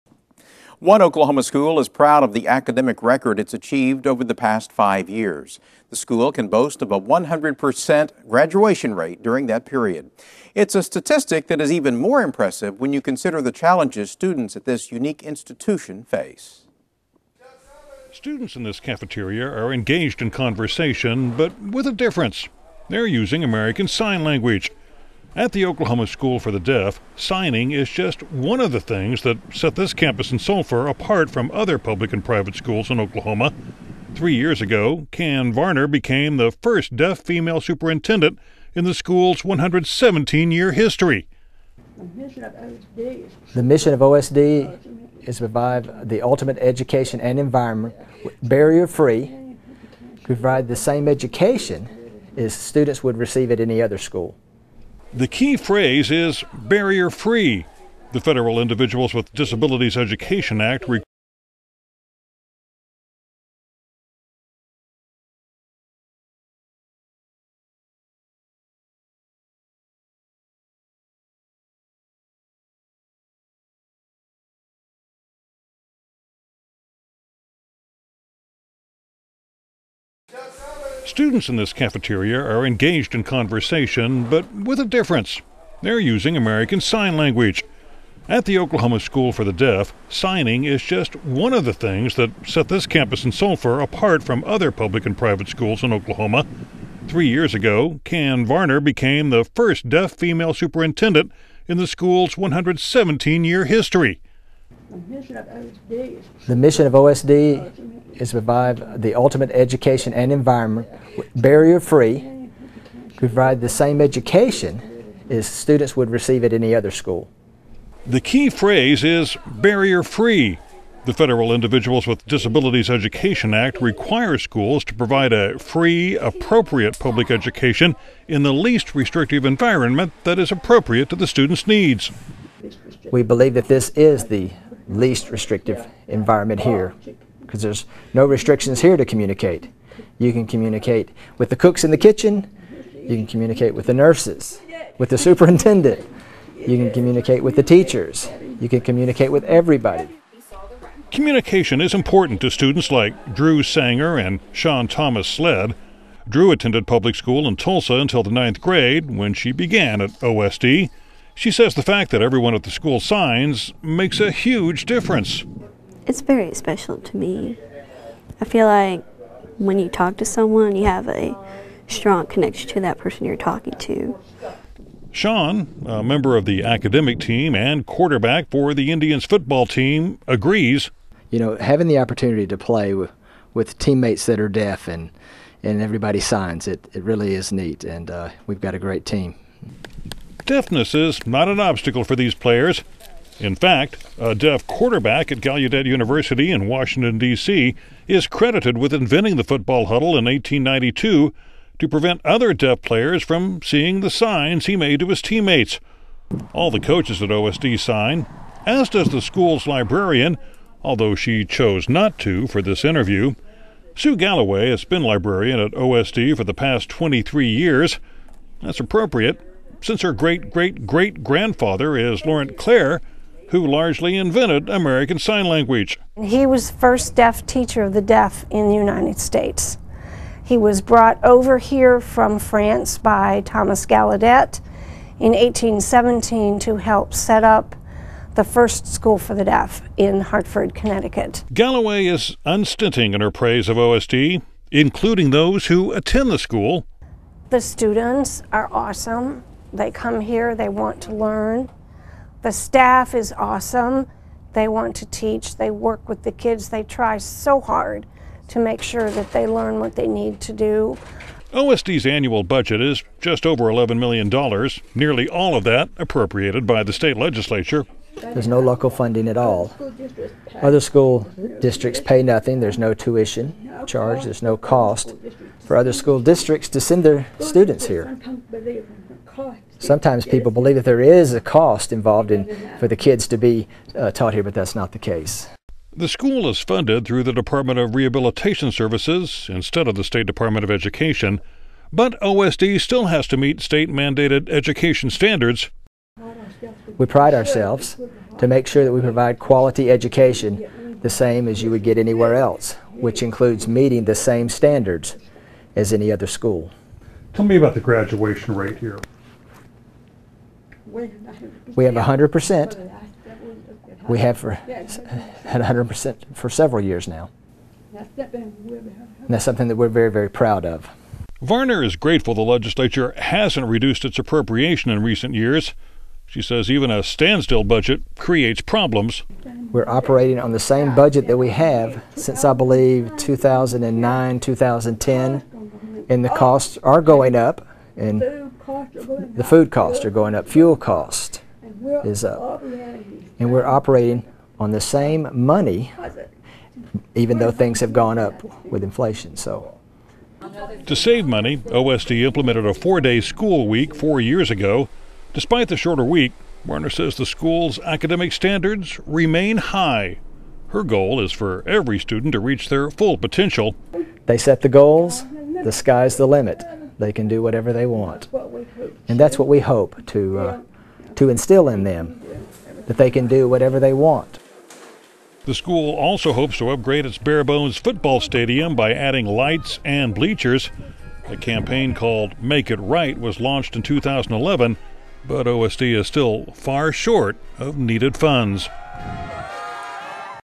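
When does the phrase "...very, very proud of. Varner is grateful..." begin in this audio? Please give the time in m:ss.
5:19.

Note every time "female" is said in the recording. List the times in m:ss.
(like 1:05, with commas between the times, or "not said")
0:37, 1:40.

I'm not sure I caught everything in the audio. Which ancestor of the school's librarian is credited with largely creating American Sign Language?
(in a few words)
Laurent Clerc.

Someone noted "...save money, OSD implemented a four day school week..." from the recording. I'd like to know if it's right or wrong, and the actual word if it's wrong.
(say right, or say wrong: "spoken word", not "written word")
right.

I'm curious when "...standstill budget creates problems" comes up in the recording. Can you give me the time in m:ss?
5:27.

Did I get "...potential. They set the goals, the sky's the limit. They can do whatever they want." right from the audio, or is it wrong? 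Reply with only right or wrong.
right.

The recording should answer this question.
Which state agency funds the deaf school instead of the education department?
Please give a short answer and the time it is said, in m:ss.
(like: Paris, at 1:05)
Department of Rehabilitation Services, at 4:47.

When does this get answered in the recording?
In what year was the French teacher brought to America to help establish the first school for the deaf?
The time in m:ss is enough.
3:55.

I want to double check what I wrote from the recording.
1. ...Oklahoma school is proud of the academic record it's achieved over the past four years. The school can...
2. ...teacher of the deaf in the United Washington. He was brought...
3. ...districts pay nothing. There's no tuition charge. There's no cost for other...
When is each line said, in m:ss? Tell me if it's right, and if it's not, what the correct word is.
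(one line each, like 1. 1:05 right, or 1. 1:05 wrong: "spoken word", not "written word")
1. 0:01 wrong: "five", not "four"
2. 3:47 wrong: "States", not "Washington"
3. 4:31 right.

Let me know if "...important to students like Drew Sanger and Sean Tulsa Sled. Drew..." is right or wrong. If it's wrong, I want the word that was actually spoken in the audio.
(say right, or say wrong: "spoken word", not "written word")
wrong: "Thomas", not "Tulsa".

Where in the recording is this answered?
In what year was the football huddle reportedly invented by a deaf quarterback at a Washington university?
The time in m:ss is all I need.
3:20.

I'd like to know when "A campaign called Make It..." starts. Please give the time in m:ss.
6:21.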